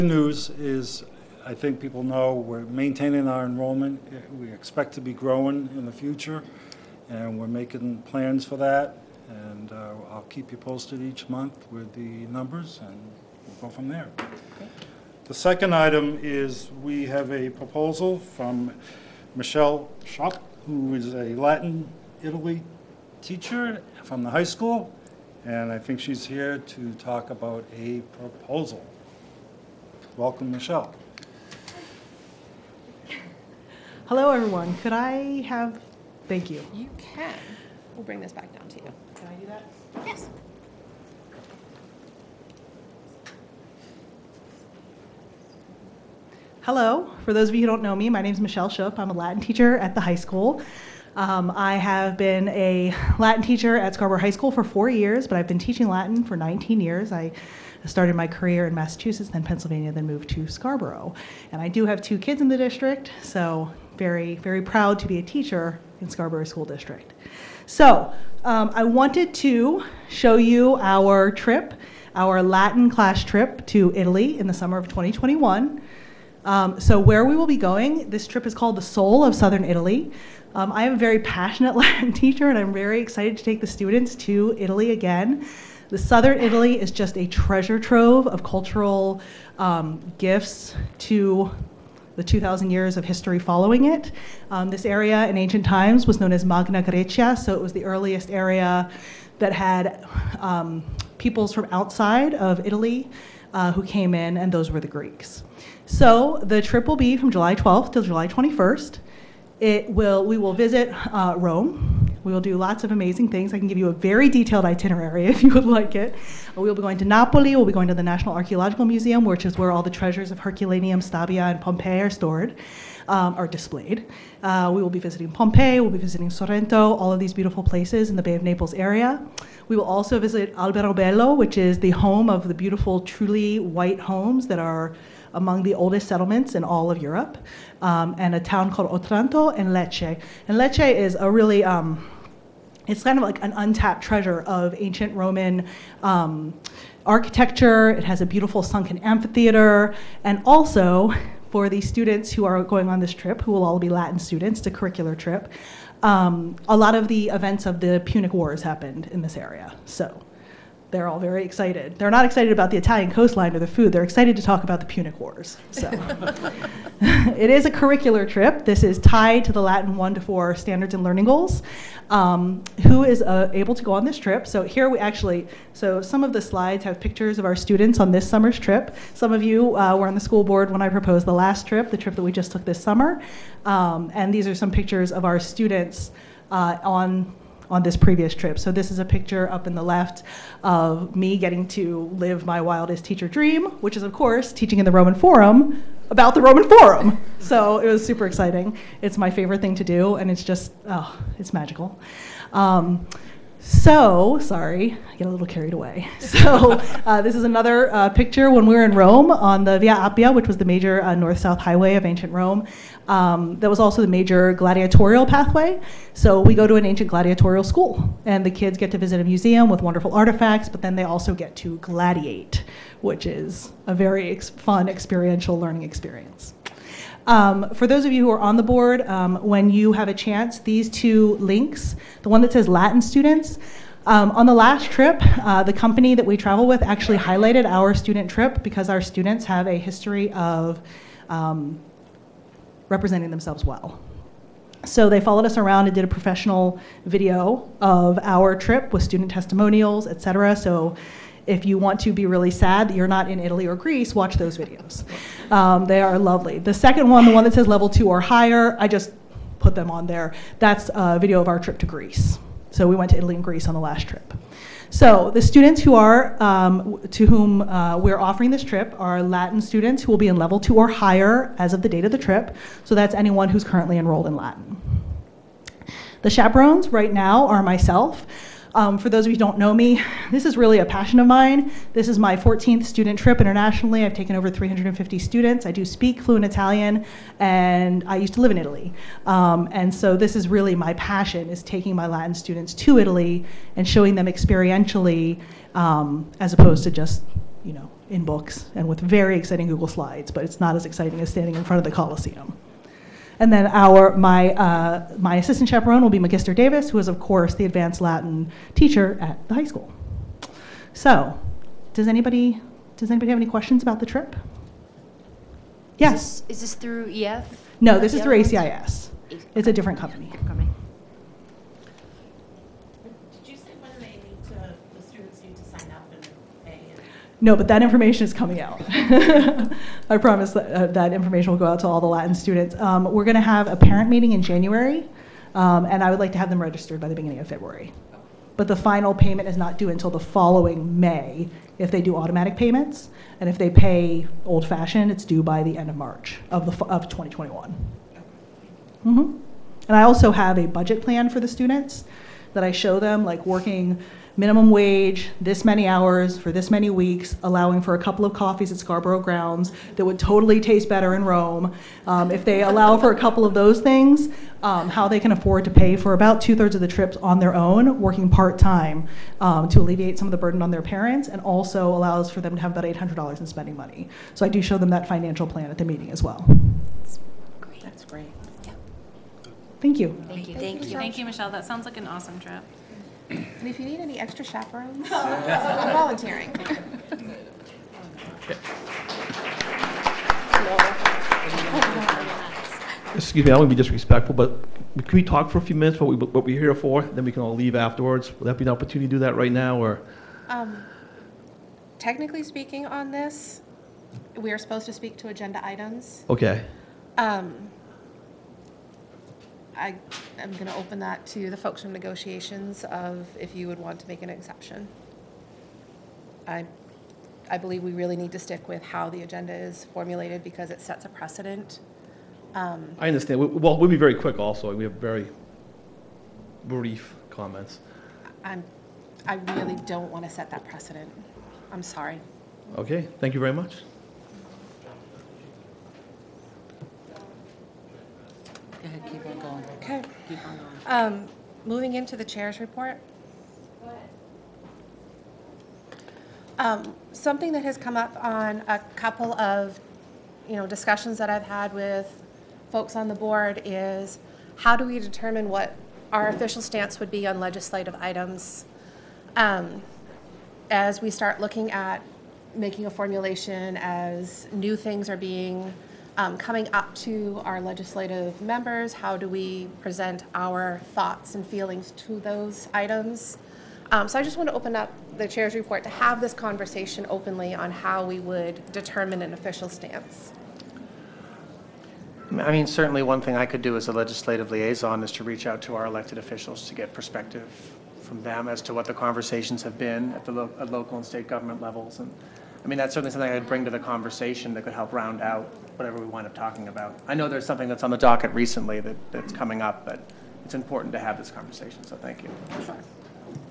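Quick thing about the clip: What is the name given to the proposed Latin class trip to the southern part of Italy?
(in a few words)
Soul of Southern Italy.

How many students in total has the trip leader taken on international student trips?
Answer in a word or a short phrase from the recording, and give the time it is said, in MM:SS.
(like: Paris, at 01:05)
over 350, at 04:44.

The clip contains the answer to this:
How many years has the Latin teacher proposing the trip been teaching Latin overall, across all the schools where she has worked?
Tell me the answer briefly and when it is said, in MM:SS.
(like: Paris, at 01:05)
19, at 00:56.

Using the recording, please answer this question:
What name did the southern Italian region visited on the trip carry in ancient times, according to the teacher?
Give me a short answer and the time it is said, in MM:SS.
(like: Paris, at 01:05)
Magna Grecia, at 01:36.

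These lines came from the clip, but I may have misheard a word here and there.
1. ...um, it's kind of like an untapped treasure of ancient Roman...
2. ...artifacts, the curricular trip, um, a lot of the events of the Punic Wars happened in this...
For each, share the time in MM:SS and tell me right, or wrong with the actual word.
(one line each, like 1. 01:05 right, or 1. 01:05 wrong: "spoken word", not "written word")
1. 02:21 right
2. 02:34 wrong: "students", not "artifacts".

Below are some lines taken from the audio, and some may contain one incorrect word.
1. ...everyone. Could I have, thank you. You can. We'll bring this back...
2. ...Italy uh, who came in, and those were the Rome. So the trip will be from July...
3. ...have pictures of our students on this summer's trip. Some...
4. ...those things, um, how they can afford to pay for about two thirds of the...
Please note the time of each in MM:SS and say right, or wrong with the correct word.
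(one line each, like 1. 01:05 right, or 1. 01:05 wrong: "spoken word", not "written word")
1. 00:34 right
2. 01:42 wrong: "Greeks", not "Rome"
3. 02:56 right
4. 06:03 right.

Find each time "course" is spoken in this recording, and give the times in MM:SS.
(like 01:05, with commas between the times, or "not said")
03:14, 05:07.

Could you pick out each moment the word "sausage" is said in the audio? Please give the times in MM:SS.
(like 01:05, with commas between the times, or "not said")
not said.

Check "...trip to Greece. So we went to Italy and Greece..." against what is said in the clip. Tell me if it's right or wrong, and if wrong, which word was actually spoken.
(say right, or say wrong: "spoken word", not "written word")
right.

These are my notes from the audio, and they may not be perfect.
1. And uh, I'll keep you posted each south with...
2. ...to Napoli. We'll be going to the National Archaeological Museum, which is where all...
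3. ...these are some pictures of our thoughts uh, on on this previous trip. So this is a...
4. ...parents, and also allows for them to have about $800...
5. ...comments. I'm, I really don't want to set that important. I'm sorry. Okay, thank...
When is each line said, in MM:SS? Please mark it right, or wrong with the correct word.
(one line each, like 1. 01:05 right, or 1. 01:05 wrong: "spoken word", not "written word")
1. 00:09 wrong: "month", not "south"
2. 01:56 right
3. 03:04 wrong: "students", not "thoughts"
4. 06:10 right
5. 07:07 wrong: "precedent", not "important".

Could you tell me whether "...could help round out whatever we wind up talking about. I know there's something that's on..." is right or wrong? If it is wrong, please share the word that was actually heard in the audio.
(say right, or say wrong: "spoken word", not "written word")
right.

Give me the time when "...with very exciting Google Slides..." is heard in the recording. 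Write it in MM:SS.
04:58.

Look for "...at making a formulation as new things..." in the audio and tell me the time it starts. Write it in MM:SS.
07:41.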